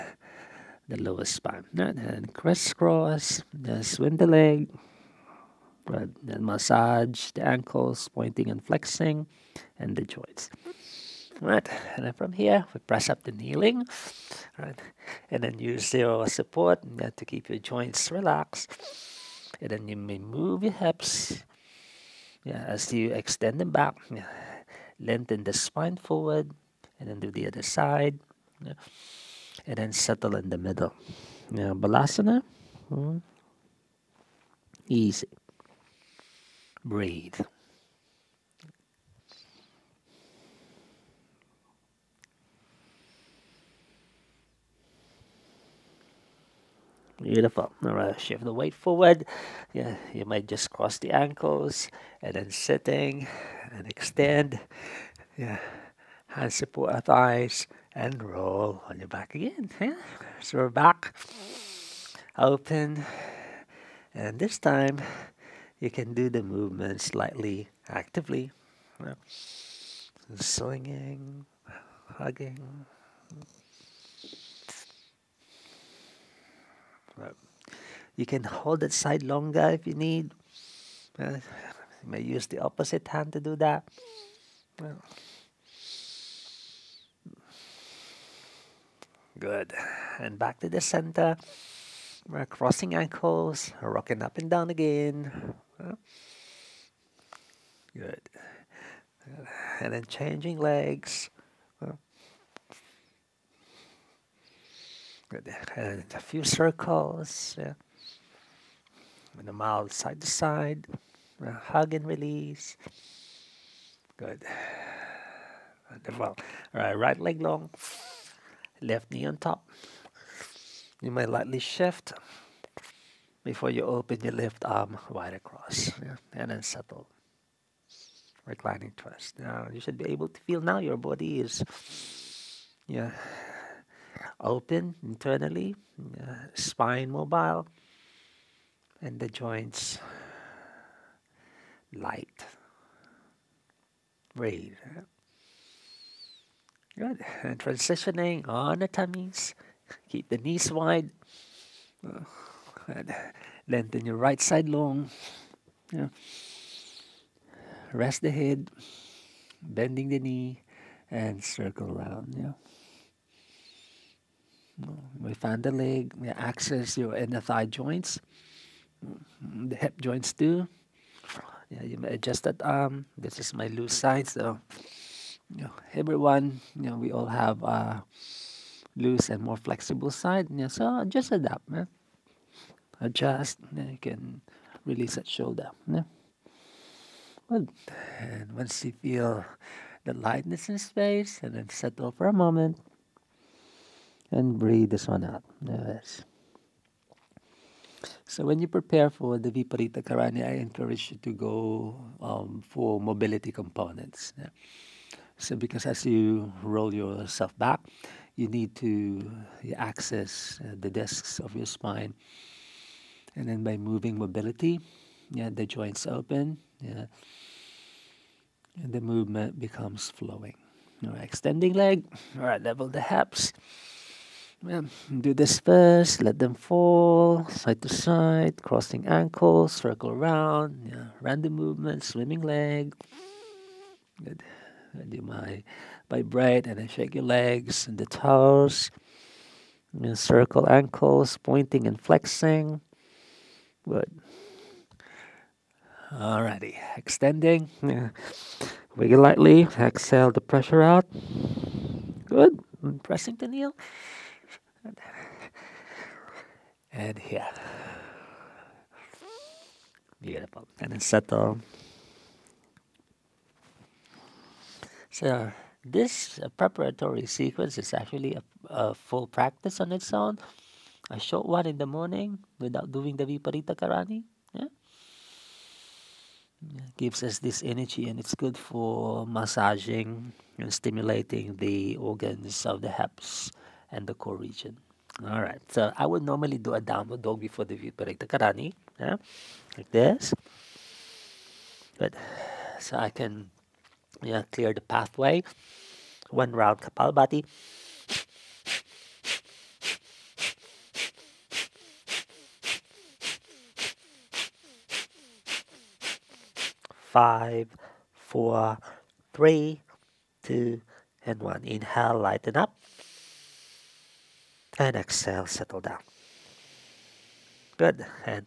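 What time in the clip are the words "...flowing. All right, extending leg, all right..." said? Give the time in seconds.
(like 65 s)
220 s.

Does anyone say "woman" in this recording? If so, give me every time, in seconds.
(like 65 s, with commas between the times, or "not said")
not said.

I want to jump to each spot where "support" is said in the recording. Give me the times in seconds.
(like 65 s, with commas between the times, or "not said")
16 s, 56 s.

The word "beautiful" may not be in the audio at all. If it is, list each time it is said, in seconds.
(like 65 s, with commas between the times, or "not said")
47 s, 260 s.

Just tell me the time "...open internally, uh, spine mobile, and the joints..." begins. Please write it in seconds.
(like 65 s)
134 s.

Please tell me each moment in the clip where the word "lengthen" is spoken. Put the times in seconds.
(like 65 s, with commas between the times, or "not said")
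25 s, 153 s.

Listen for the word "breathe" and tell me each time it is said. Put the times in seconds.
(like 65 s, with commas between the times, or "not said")
36 s, 144 s, 194 s.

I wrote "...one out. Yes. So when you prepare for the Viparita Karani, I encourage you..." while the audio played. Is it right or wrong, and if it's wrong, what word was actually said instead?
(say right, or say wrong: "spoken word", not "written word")
right.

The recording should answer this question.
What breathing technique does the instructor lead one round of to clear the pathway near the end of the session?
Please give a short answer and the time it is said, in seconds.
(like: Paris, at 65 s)
Kapalbhati, at 296 s.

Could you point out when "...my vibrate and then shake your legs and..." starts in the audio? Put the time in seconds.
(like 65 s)
235 s.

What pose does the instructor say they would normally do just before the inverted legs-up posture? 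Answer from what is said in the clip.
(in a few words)
Downward dog.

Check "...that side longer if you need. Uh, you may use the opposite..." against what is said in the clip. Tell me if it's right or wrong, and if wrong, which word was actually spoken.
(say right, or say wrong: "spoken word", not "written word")
right.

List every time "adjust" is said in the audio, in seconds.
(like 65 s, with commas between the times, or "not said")
172 s, 183 s.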